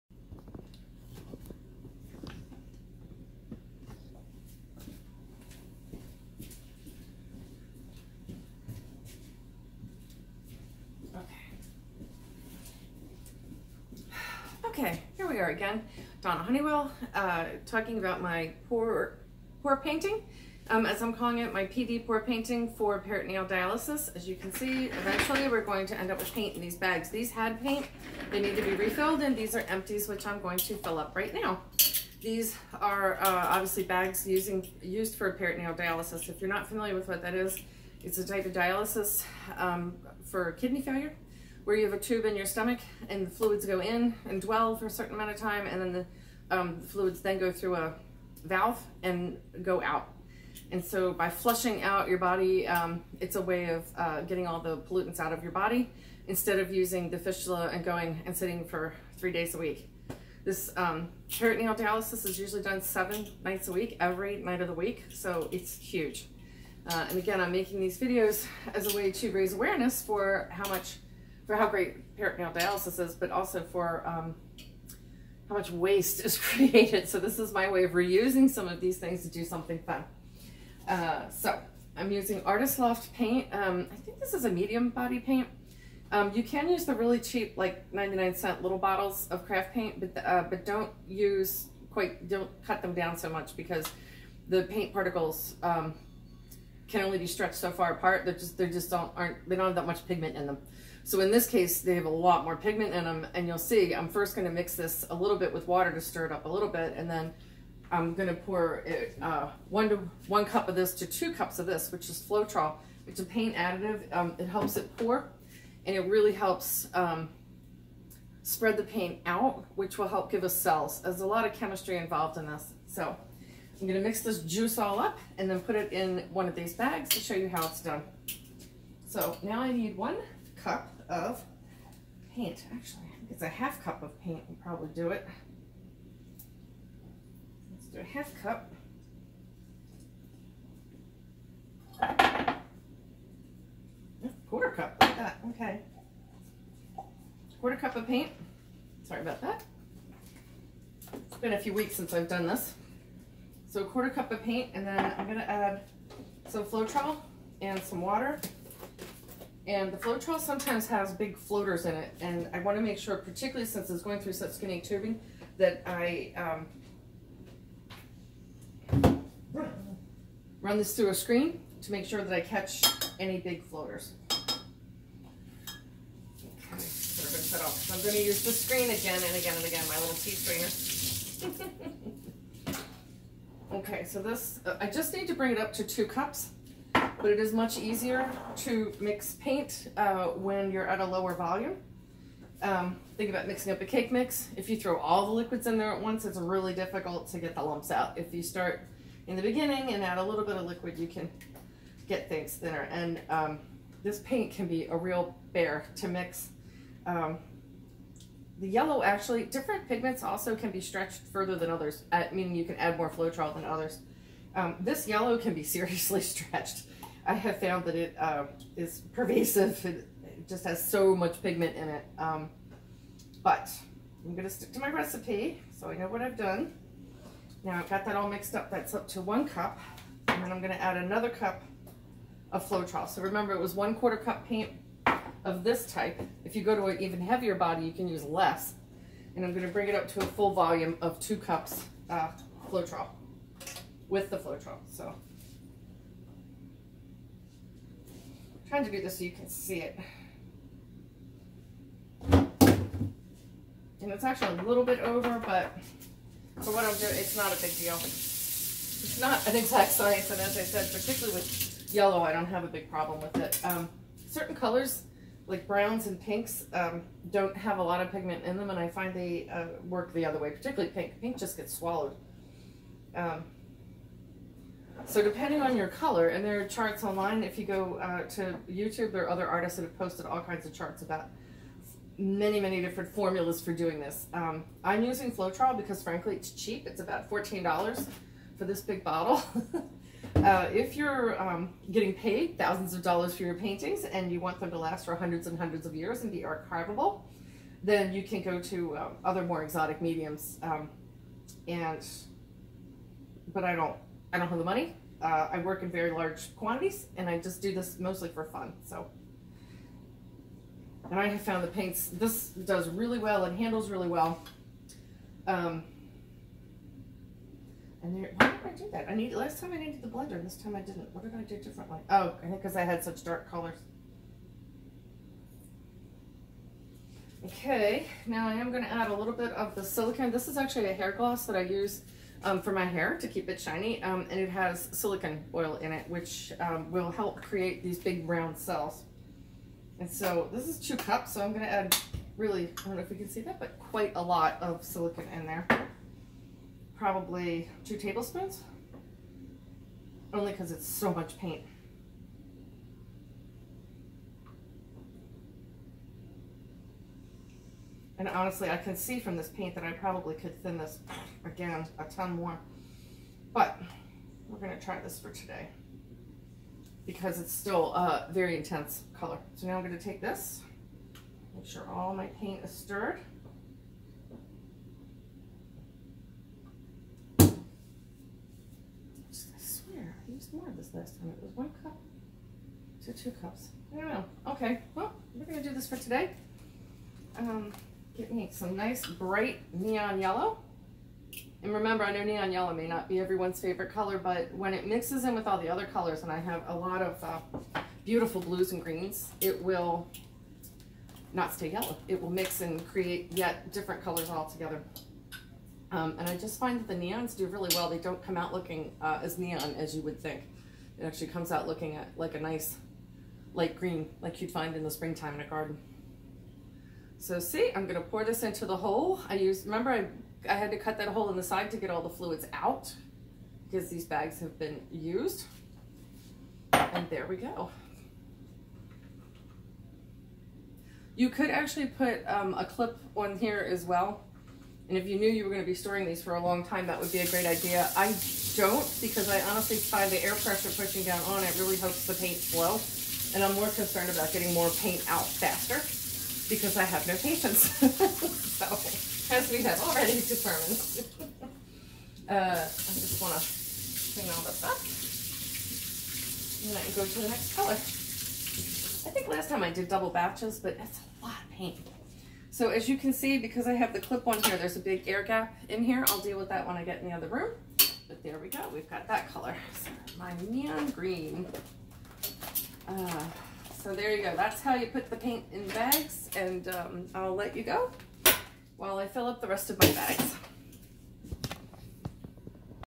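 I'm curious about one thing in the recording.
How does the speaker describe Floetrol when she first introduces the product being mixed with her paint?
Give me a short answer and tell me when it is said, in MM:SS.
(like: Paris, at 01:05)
A paint additive, at 01:53.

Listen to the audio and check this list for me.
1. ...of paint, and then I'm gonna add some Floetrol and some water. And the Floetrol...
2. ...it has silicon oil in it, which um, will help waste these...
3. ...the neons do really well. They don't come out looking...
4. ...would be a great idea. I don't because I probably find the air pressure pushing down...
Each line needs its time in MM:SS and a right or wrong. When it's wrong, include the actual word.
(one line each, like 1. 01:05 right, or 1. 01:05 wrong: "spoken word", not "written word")
1. 02:34 right
2. 05:34 wrong: "create", not "waste"
3. 06:46 right
4. 07:16 wrong: "honestly", not "probably".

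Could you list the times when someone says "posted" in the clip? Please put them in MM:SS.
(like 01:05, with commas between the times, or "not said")
04:39.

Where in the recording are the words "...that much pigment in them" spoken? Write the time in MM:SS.
01:39.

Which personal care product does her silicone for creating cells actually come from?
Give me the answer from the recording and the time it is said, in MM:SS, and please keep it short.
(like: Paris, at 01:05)
Hair gloss, at 05:30.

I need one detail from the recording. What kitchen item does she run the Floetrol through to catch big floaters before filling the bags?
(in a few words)
Tea strainer.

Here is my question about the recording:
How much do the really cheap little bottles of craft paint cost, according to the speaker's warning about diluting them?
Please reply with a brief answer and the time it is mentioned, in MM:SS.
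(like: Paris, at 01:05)
99 cents, at 01:27.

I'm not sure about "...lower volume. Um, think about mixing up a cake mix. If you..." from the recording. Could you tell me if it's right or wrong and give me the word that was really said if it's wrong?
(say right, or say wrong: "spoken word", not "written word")
right.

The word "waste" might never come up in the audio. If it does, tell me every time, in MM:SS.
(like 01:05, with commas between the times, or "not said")
01:15.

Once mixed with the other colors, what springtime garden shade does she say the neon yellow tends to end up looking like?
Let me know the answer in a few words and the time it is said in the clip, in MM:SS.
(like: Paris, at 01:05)
Light green, at 06:53.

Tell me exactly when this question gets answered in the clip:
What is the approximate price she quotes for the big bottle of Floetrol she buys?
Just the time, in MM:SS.
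04:47.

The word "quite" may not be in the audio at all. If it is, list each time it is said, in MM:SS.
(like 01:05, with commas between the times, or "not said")
01:31, 05:43.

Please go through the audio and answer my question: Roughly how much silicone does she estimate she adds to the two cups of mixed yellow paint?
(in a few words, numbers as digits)
2 tablespoons.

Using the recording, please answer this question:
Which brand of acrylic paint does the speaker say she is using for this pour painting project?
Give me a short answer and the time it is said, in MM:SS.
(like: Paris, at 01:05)
Artist Loft, at 01:22.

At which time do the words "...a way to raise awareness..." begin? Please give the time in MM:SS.
01:08.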